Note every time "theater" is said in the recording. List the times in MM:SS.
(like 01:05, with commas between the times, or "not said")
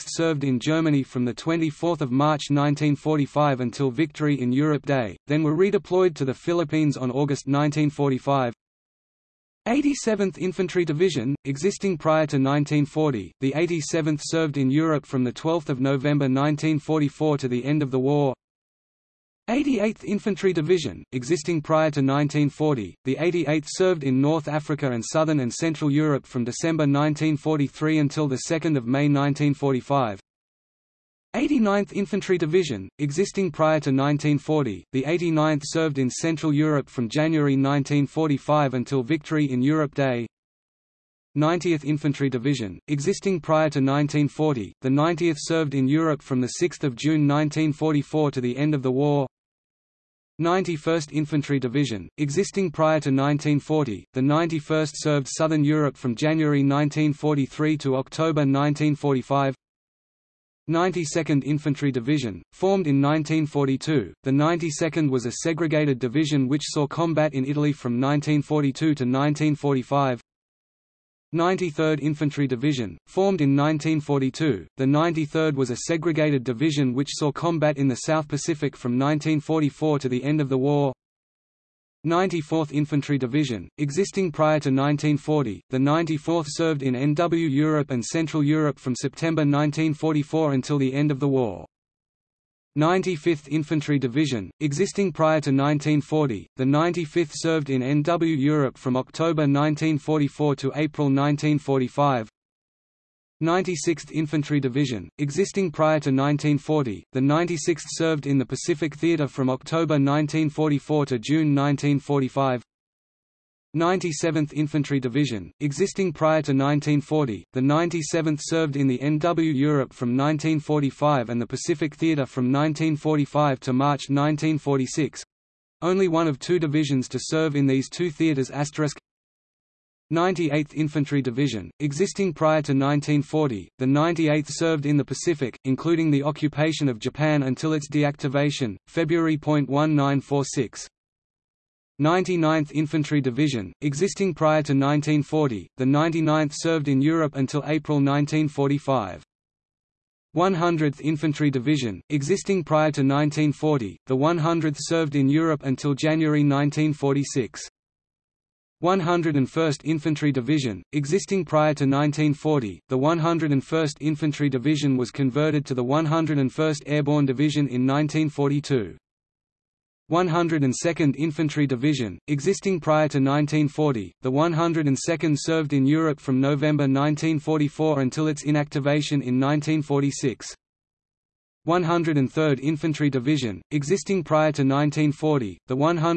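01:48, 02:01, 02:08.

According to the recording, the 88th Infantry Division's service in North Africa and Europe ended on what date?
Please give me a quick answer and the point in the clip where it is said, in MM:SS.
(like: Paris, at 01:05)
2 May 1945, at 00:28.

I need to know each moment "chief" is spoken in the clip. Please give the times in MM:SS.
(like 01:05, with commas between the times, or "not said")
not said.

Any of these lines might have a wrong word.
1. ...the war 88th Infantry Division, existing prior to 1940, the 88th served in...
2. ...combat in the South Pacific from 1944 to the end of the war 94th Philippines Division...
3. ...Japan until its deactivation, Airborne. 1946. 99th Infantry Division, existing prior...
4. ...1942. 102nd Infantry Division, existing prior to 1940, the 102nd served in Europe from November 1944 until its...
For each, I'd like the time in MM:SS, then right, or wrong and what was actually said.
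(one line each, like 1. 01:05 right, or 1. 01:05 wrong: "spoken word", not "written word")
1. 00:17 right
2. 01:17 wrong: "Infantry", not "Philippines"
3. 02:16 wrong: "February", not "Airborne"
4. 02:47 right.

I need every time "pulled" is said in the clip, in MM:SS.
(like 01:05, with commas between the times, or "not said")
not said.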